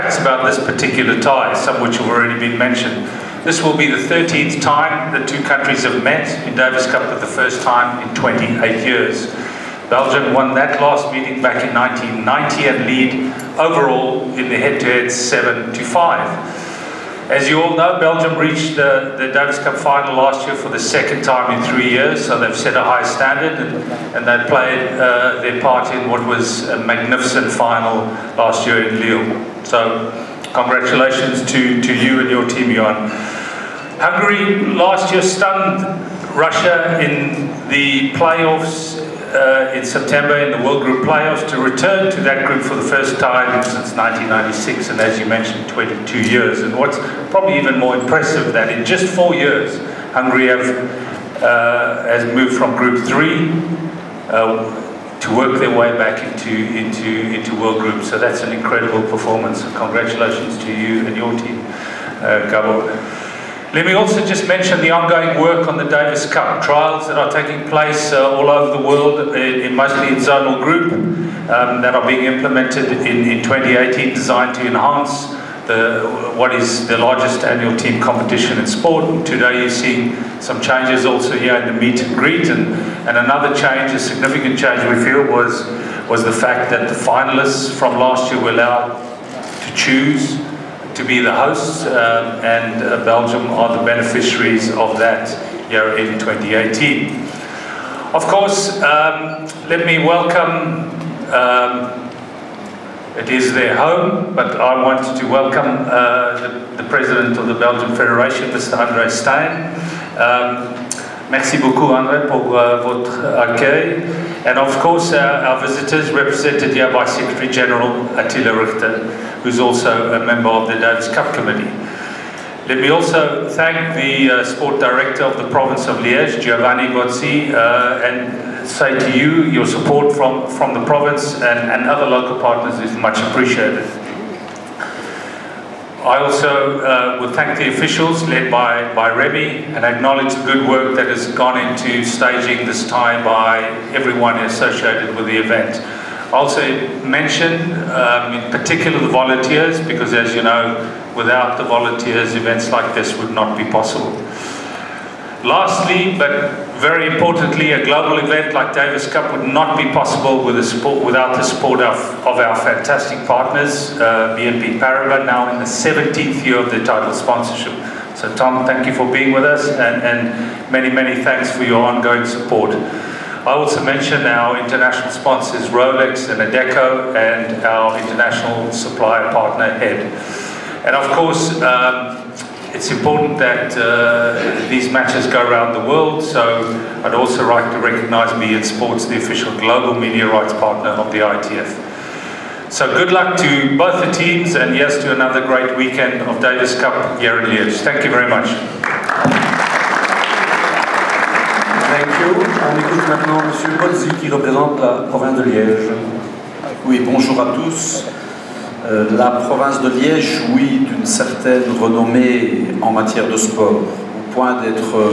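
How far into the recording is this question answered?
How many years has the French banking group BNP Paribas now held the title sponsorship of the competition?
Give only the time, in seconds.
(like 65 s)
165 s.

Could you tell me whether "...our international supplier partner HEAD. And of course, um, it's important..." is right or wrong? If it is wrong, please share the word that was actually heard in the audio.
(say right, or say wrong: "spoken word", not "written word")
right.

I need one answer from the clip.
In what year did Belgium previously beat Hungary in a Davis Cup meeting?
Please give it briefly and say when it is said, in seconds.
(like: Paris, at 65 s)
1990, at 11 s.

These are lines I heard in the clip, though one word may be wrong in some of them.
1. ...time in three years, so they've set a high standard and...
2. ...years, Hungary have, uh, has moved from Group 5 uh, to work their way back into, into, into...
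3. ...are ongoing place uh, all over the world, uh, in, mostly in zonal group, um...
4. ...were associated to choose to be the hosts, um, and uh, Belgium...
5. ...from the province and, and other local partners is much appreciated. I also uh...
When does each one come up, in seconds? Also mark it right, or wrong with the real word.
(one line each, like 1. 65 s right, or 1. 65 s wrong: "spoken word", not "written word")
1. 21 s right
2. 49 s wrong: "3", not "5"
3. 67 s wrong: "taking", not "ongoing"
4. 88 s wrong: "allowed", not "associated"
5. 130 s right.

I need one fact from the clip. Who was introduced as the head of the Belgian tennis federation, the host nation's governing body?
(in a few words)
André Stein.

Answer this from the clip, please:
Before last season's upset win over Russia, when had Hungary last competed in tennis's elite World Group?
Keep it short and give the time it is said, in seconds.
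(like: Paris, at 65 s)
1996, at 43 s.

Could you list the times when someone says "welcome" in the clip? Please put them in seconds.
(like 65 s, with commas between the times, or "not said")
99 s, 105 s.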